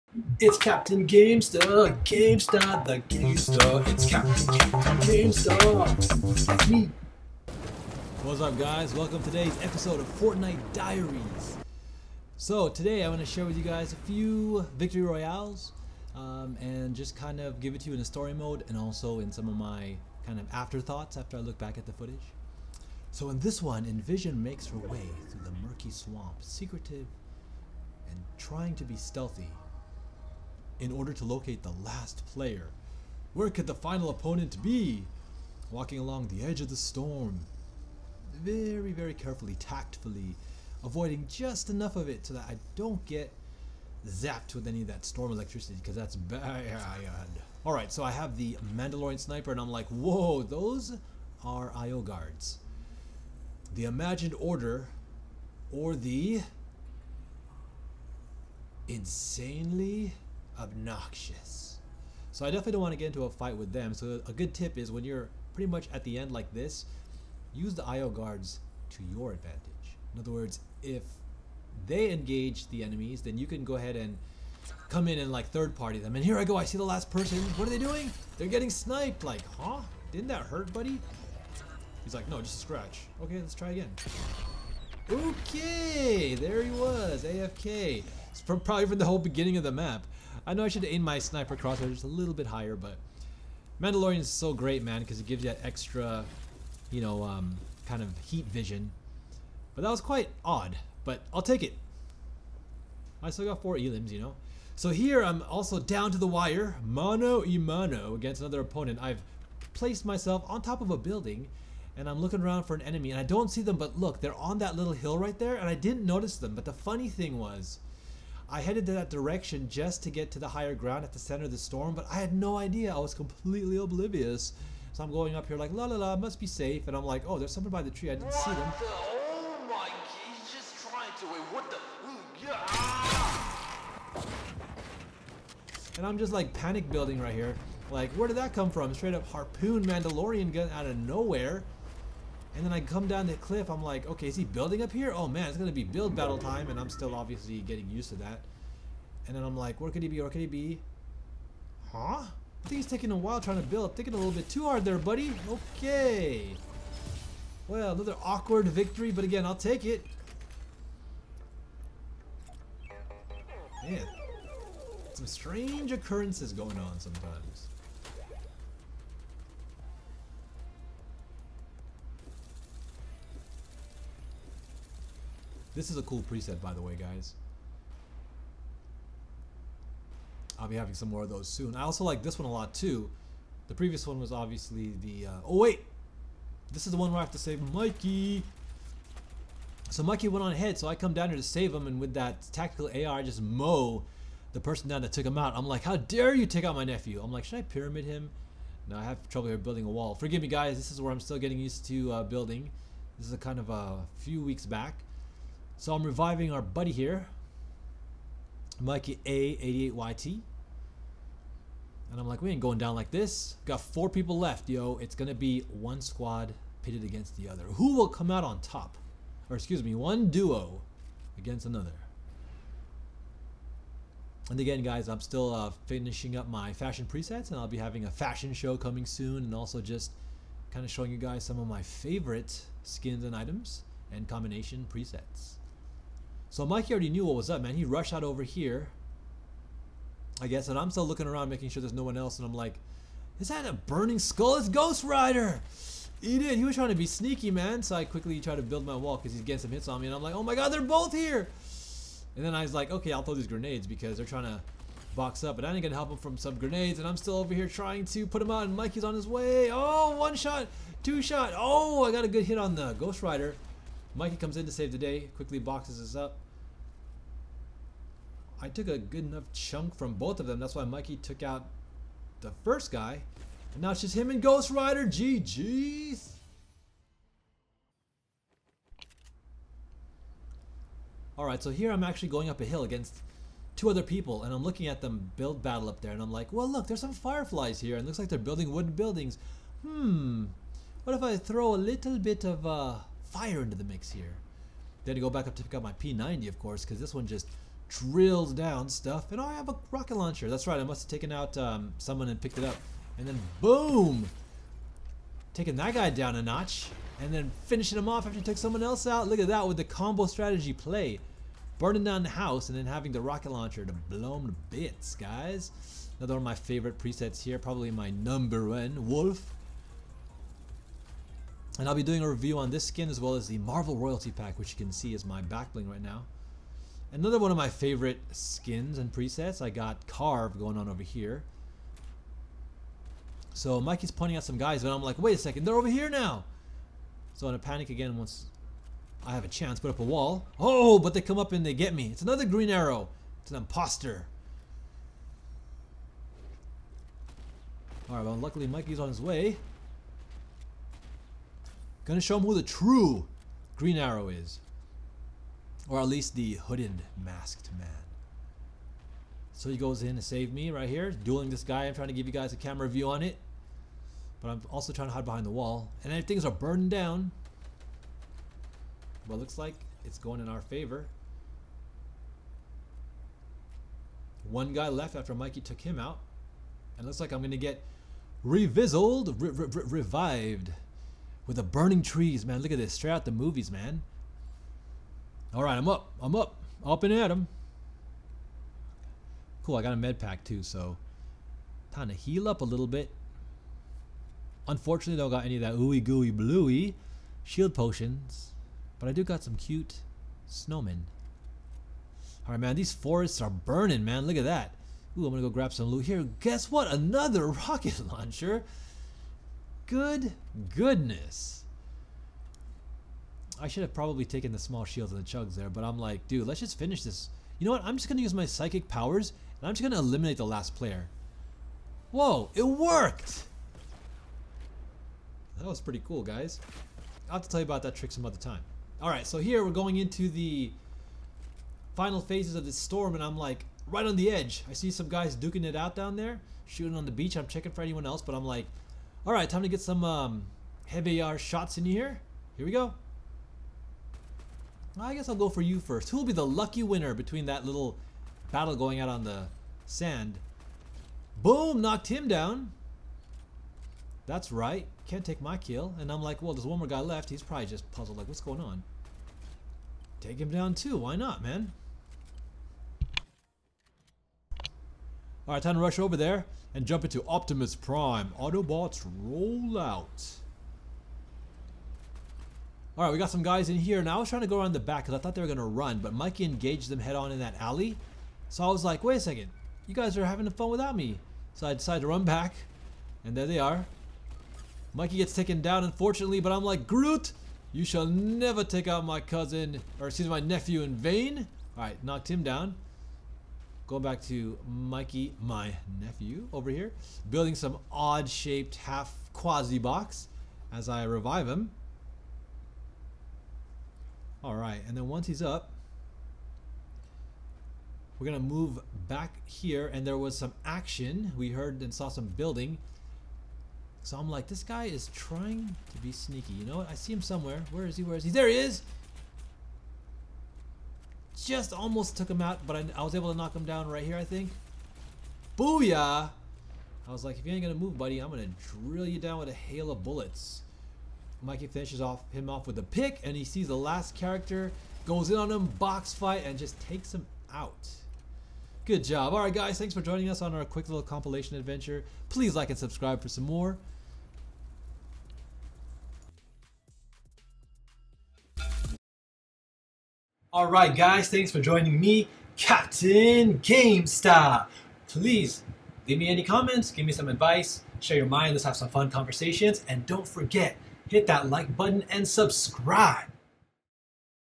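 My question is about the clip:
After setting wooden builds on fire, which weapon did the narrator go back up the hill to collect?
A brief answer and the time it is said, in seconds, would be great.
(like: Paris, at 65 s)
P90, at 295 s.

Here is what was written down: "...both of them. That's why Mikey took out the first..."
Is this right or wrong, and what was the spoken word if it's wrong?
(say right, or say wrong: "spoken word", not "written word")
right.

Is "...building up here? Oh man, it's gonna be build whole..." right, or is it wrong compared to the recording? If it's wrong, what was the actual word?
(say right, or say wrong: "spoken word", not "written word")
wrong: "battle", not "whole".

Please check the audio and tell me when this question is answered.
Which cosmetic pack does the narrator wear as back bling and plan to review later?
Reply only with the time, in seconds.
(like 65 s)
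323 s.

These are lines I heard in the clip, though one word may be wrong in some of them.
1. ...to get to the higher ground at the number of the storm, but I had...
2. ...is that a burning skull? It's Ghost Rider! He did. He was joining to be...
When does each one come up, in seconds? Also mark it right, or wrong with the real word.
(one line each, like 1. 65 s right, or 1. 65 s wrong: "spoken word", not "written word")
1. 120 s wrong: "center", not "number"
2. 243 s wrong: "trying", not "joining".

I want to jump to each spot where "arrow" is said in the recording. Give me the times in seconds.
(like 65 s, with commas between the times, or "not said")
342 s, 353 s.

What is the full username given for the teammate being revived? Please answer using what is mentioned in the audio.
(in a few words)
Mikey A88YT.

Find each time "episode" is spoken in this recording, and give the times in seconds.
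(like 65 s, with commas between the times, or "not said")
9 s.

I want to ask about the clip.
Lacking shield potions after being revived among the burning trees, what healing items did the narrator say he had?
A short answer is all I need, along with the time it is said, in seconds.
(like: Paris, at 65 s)
snowmen, at 400 s.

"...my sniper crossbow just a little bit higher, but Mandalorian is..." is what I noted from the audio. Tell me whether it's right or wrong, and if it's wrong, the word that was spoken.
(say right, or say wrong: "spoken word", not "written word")
right.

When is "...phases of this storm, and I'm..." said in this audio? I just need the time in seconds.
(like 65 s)
432 s.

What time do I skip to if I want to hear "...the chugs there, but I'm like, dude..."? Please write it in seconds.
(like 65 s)
415 s.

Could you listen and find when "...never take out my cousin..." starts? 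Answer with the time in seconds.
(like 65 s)
488 s.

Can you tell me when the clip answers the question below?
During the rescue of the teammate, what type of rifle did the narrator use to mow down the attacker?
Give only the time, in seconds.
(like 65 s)
192 s.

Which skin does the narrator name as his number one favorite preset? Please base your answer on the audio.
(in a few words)
Wolf.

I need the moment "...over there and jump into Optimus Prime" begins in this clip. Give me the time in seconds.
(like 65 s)
465 s.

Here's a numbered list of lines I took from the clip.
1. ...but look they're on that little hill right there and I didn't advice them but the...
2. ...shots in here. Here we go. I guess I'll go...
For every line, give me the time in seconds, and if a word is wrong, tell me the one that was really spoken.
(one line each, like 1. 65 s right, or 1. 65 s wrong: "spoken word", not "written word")
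1. 113 s wrong: "notice", not "advice"
2. 441 s right.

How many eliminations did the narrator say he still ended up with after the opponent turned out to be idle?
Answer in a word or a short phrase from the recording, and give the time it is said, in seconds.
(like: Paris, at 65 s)
4, at 103 s.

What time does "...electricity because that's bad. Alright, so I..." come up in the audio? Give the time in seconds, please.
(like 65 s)
45 s.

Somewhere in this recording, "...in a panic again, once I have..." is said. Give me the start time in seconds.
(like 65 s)
337 s.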